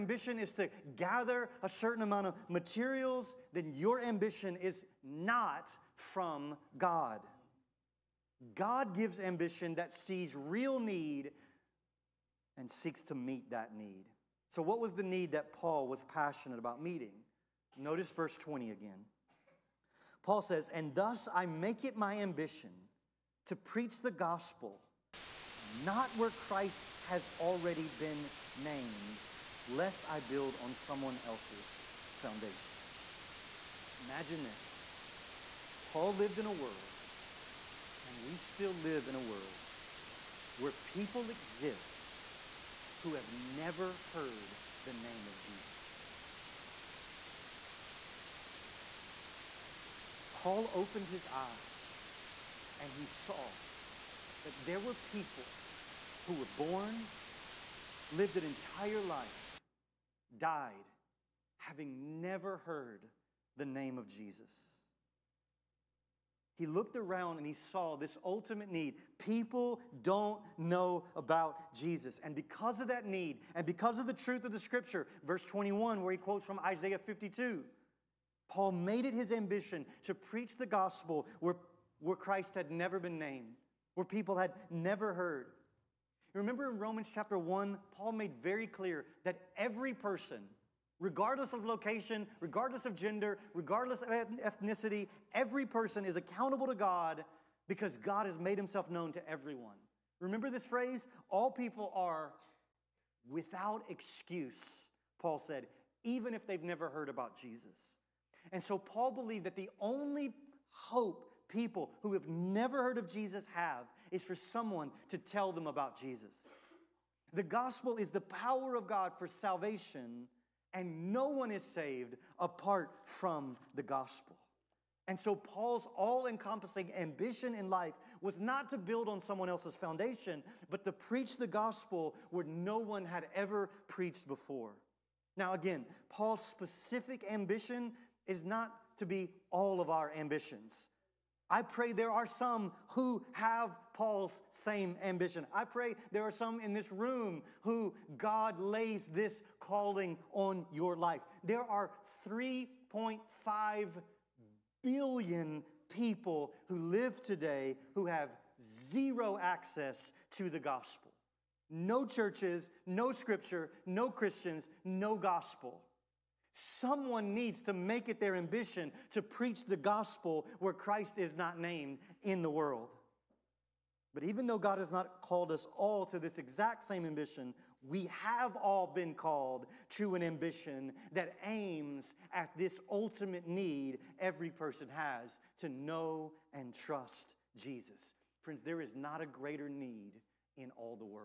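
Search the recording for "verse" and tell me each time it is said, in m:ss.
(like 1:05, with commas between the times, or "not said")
0:18, 1:15.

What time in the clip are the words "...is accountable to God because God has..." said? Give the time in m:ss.
1:36.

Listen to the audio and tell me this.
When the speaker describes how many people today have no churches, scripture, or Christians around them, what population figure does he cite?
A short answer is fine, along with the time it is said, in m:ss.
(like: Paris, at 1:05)
3.5 billion, at 2:32.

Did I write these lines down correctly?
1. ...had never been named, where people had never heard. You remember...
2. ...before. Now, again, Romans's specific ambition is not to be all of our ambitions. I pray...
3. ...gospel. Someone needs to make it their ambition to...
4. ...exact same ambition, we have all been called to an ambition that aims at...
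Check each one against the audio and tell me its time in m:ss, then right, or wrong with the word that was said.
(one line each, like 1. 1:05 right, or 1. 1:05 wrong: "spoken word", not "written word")
1. 1:22 right
2. 2:14 wrong: "Paul", not "Romans"
3. 2:45 right
4. 2:56 right.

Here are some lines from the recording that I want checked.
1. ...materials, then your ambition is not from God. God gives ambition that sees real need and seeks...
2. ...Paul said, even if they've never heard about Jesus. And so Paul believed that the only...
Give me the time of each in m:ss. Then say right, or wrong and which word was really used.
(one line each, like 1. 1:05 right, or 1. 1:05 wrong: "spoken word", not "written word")
1. 0:02 right
2. 1:45 right.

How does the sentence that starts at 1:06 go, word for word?
He looked around and he saw this ultimate need.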